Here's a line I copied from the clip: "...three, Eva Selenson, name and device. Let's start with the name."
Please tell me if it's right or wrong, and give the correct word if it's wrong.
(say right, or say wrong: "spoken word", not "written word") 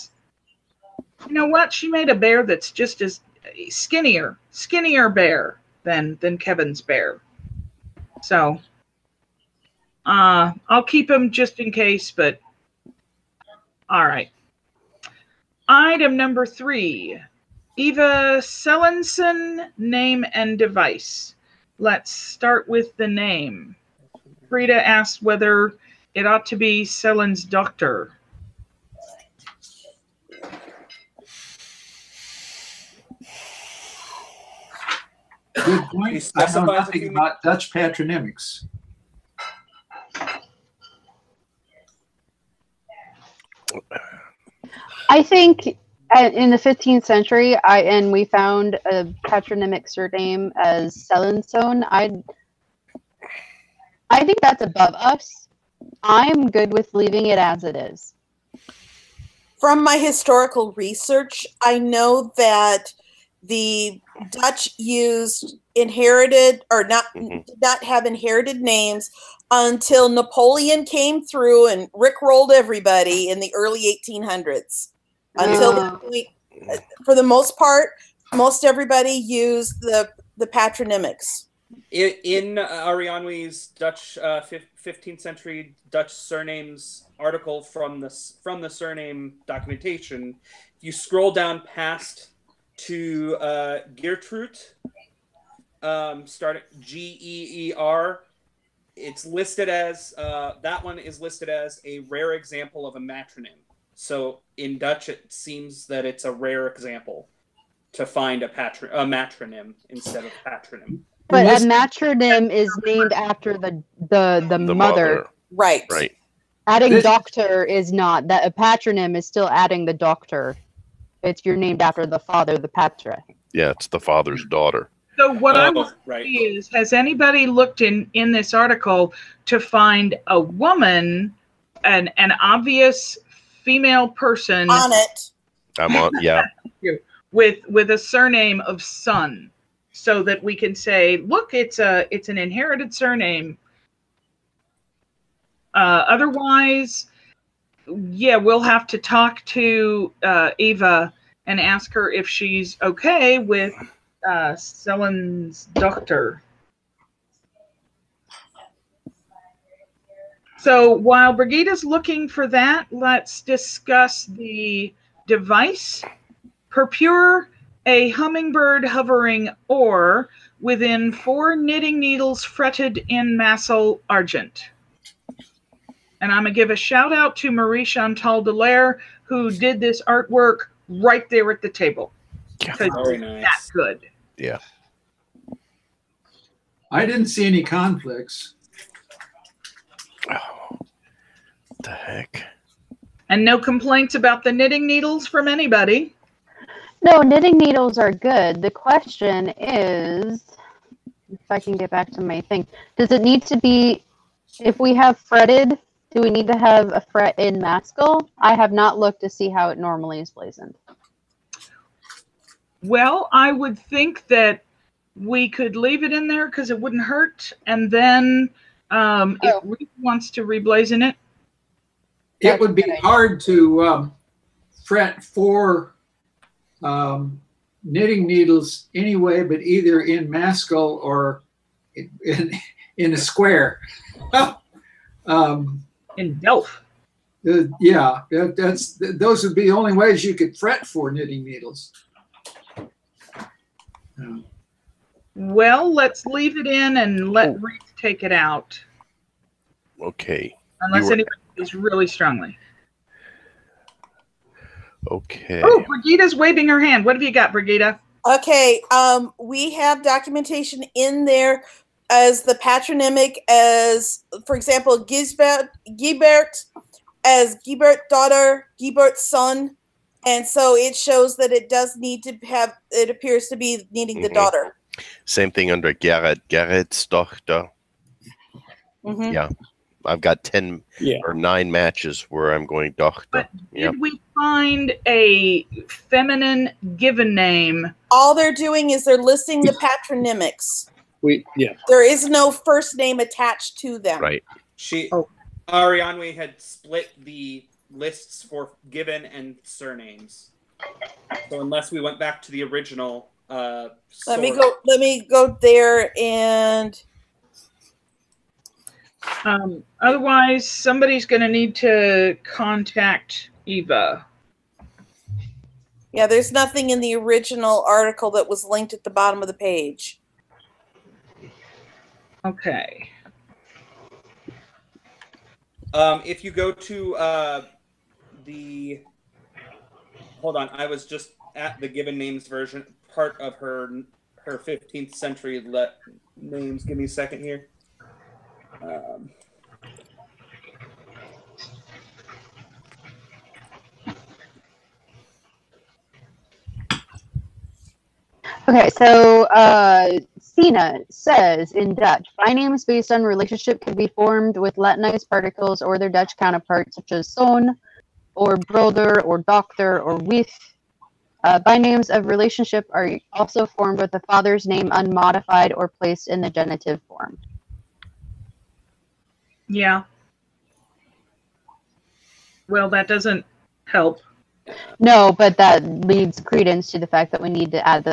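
right.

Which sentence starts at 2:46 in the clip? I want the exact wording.
purpure, a hummingbird hovering or within four knitting needles fretted in mascle argent.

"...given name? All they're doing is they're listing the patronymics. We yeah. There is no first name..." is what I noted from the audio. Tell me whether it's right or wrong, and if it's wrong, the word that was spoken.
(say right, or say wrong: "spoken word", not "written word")
right.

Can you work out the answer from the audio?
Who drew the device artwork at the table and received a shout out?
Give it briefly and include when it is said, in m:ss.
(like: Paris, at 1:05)
Marie Chantal Delaire, at 2:57.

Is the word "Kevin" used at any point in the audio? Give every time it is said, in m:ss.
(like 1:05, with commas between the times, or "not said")
0:06.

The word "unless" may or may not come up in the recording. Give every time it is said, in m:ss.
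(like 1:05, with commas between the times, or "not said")
4:10, 5:01.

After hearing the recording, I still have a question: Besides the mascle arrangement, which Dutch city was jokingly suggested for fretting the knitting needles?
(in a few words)
Delft.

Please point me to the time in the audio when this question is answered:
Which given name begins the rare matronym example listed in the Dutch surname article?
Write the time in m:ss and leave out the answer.
1:33.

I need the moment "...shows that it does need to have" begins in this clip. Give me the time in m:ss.
4:30.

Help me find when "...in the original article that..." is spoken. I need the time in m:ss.
5:16.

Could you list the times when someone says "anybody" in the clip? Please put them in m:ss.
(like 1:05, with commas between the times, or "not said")
2:06, 3:15, 4:11.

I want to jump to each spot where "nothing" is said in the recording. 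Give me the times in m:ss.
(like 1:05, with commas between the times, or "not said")
0:36, 5:16.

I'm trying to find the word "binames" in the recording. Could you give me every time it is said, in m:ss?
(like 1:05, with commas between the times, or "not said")
5:52, 6:01.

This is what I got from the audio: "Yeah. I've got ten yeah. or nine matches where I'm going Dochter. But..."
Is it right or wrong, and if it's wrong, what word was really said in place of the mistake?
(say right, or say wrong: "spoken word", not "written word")
right.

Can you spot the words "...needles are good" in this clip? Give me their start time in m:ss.
3:17.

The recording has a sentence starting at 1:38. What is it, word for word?
It's listed as uh, that one is listed as a rare example of a matronym.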